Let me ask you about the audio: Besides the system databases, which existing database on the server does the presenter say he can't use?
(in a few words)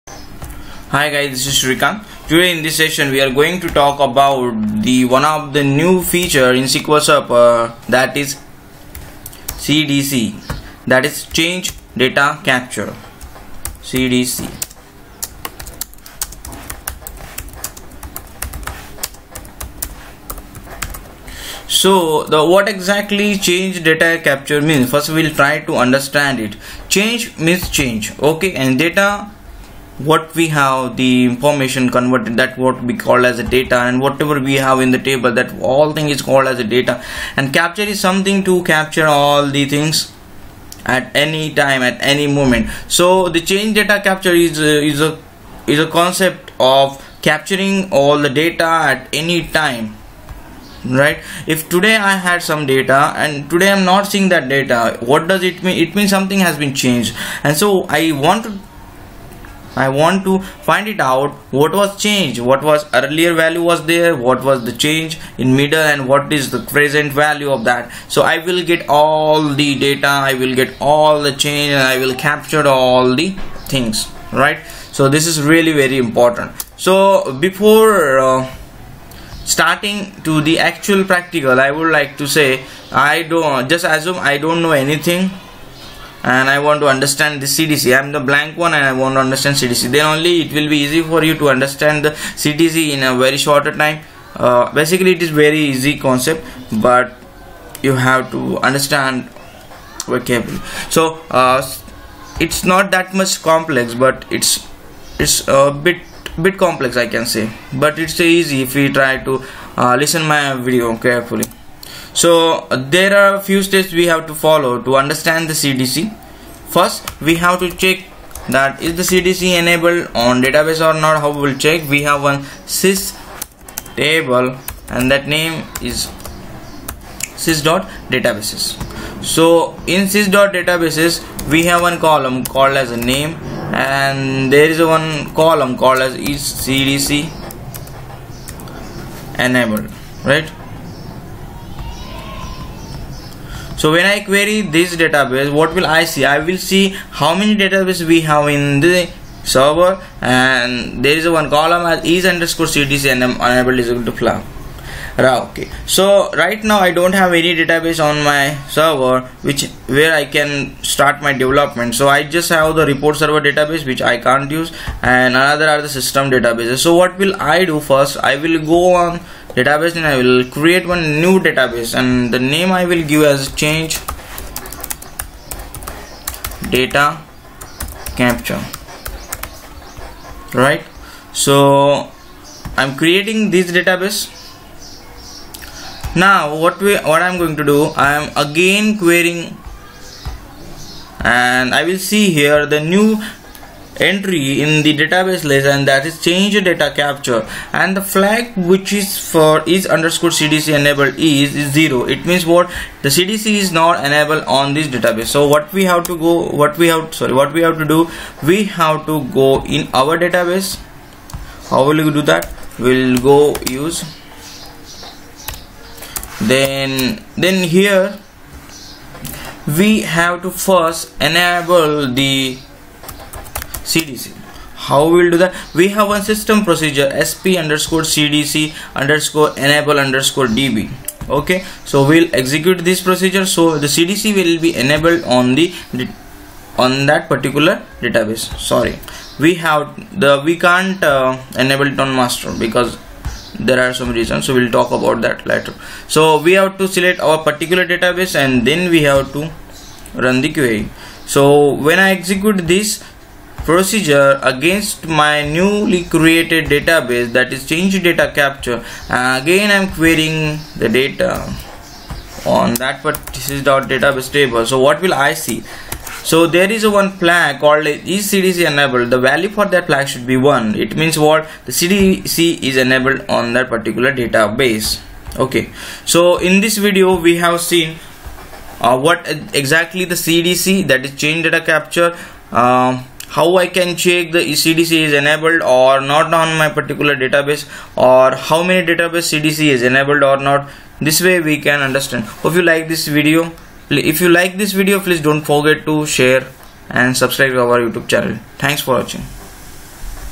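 report server.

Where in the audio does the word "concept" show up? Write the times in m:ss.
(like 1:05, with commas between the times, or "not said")
0:45, 1:35.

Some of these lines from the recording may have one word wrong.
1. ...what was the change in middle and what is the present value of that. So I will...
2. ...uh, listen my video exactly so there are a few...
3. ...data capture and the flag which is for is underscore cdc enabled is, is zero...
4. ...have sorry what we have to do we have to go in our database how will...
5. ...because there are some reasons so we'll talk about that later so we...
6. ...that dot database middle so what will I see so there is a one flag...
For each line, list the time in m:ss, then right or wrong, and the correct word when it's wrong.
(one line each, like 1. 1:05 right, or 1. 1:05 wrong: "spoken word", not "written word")
1. 1:04 right
2. 1:49 wrong: "carefully", not "exactly"
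3. 3:16 right
4. 3:26 right
5. 4:02 right
6. 4:22 wrong: "table", not "middle".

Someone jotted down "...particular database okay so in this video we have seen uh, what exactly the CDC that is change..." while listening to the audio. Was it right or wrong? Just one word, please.
right.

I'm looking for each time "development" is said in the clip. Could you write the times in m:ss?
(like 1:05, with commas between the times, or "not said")
2:41.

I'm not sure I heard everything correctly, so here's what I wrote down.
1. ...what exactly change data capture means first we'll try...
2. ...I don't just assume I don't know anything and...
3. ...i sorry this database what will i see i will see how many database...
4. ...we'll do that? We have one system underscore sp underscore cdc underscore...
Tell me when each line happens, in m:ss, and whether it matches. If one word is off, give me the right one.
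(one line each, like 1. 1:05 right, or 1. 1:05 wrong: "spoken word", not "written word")
1. 0:22 right
2. 1:22 right
3. 2:24 wrong: "query", not "sorry"
4. 3:45 wrong: "procedure", not "underscore".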